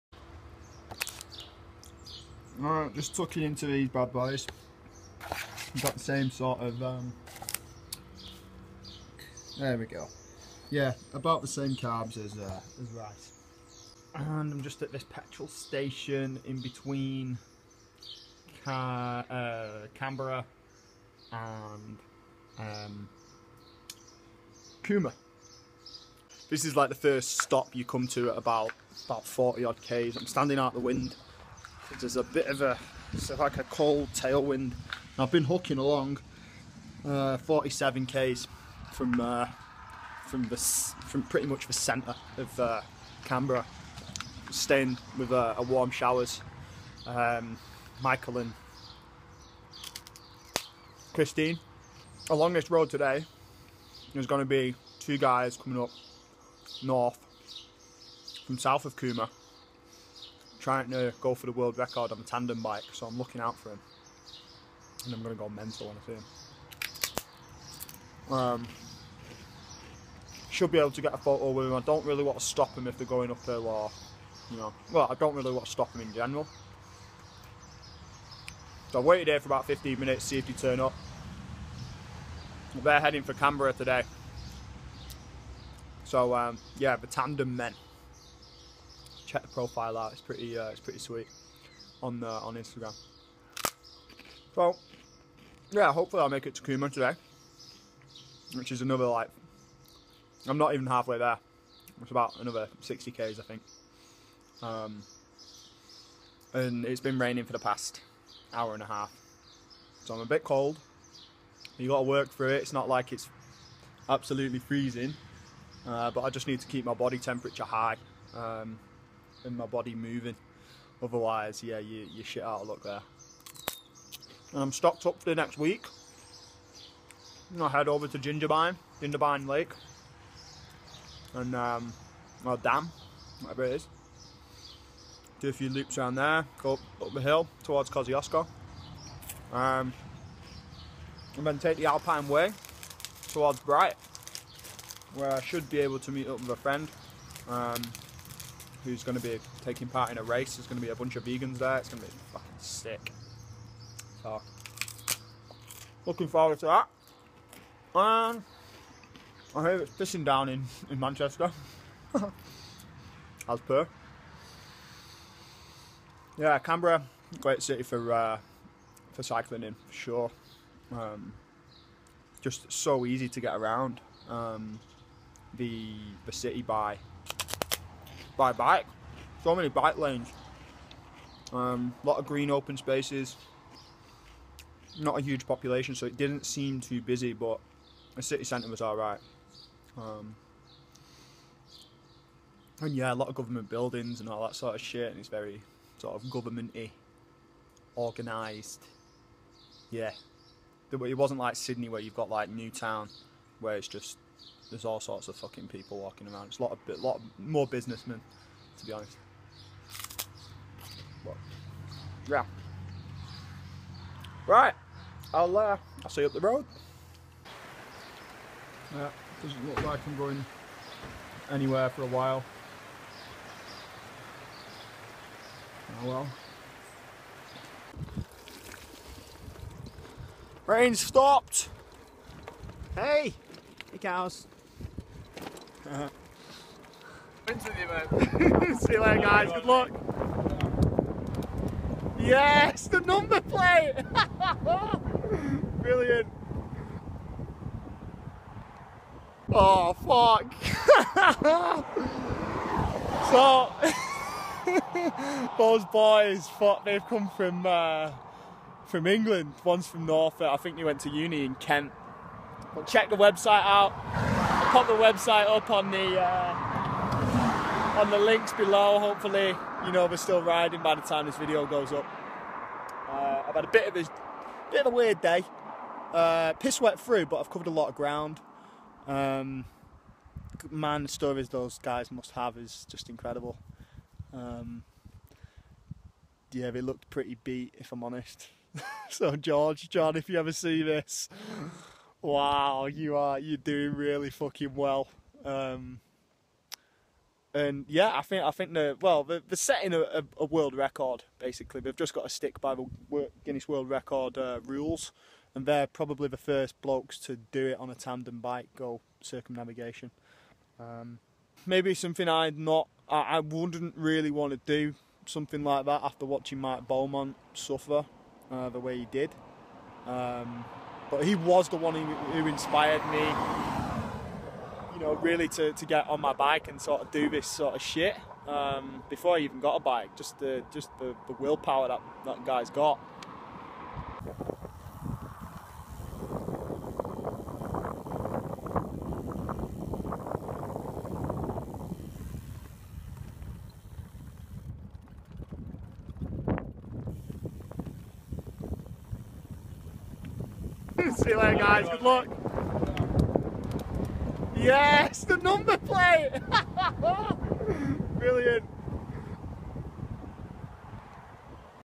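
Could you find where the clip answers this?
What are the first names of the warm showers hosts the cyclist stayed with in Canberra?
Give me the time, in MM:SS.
00:48.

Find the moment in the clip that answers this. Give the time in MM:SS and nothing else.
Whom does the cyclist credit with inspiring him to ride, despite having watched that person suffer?
05:16.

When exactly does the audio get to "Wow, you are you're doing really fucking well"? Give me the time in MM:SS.
04:52.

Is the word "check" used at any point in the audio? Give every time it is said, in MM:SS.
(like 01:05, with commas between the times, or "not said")
01:29, 04:22.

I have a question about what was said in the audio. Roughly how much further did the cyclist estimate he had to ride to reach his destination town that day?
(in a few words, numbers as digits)
60 km.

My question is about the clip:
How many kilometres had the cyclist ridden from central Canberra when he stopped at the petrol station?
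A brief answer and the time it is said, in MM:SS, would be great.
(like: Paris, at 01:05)
47, at 00:37.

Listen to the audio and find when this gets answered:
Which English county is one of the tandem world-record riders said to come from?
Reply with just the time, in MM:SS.
04:20.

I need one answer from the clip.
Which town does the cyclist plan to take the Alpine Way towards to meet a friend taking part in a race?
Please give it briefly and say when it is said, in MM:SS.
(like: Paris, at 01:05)
Bright, at 02:23.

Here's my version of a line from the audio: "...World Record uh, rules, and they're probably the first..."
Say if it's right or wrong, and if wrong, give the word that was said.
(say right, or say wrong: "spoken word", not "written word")
right.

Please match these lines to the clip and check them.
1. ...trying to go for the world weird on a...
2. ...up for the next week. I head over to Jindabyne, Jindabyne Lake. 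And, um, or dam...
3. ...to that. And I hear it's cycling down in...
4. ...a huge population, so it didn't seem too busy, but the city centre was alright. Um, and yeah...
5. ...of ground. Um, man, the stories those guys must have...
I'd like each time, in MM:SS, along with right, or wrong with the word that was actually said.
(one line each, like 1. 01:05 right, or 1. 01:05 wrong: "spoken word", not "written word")
1. 01:00 wrong: "record", not "weird"
2. 02:05 right
3. 02:36 wrong: "pissing", not "cycling"
4. 03:05 right
5. 04:37 right.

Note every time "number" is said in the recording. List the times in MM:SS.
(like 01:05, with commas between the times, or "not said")
04:03, 05:55.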